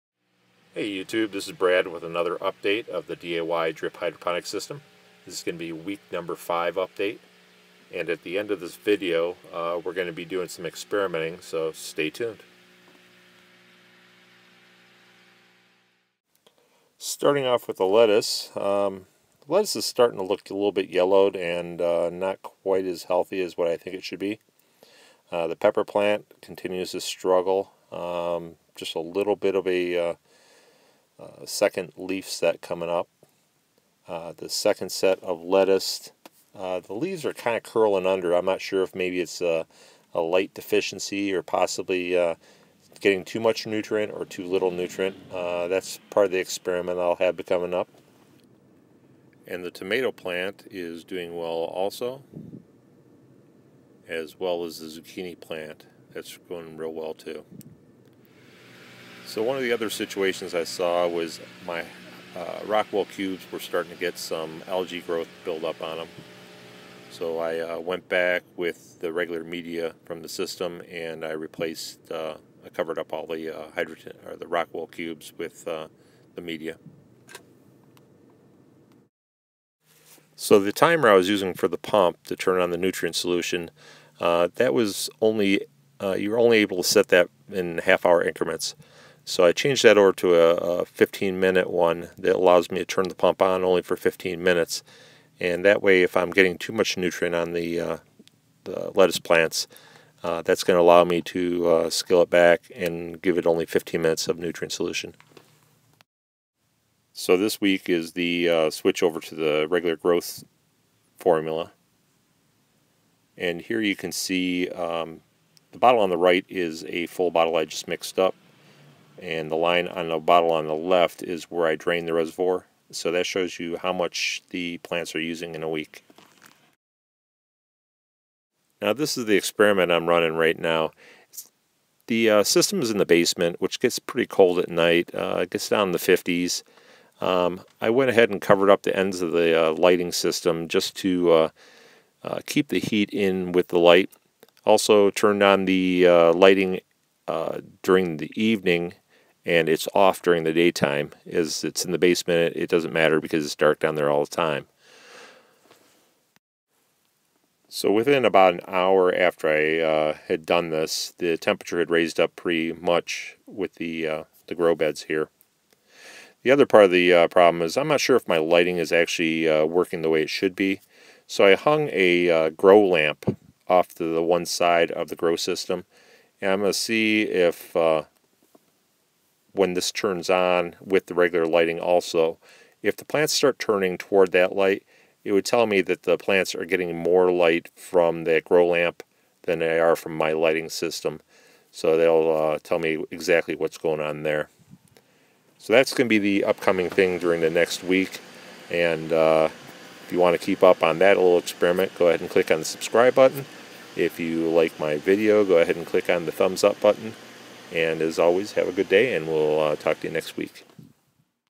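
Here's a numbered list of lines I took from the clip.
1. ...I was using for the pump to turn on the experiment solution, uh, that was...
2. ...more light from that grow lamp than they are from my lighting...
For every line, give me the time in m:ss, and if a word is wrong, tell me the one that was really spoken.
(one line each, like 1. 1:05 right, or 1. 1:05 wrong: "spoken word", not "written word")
1. 1:21 wrong: "nutrient", not "experiment"
2. 3:06 right.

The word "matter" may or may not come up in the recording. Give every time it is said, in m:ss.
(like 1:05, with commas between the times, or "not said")
2:32.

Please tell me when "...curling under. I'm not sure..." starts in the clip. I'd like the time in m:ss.
0:37.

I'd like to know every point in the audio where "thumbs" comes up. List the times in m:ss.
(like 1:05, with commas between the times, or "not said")
3:26.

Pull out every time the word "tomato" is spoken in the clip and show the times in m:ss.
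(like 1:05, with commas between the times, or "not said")
0:49.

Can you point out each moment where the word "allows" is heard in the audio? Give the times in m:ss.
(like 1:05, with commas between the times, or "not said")
1:32, 1:40.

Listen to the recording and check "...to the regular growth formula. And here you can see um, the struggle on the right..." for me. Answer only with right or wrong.
wrong.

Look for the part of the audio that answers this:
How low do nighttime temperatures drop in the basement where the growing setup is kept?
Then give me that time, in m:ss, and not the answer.
2:15.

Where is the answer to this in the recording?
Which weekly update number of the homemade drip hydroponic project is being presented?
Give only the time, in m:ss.
0:05.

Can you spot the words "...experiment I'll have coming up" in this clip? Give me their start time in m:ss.
0:46.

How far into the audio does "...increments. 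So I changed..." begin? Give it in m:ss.
1:28.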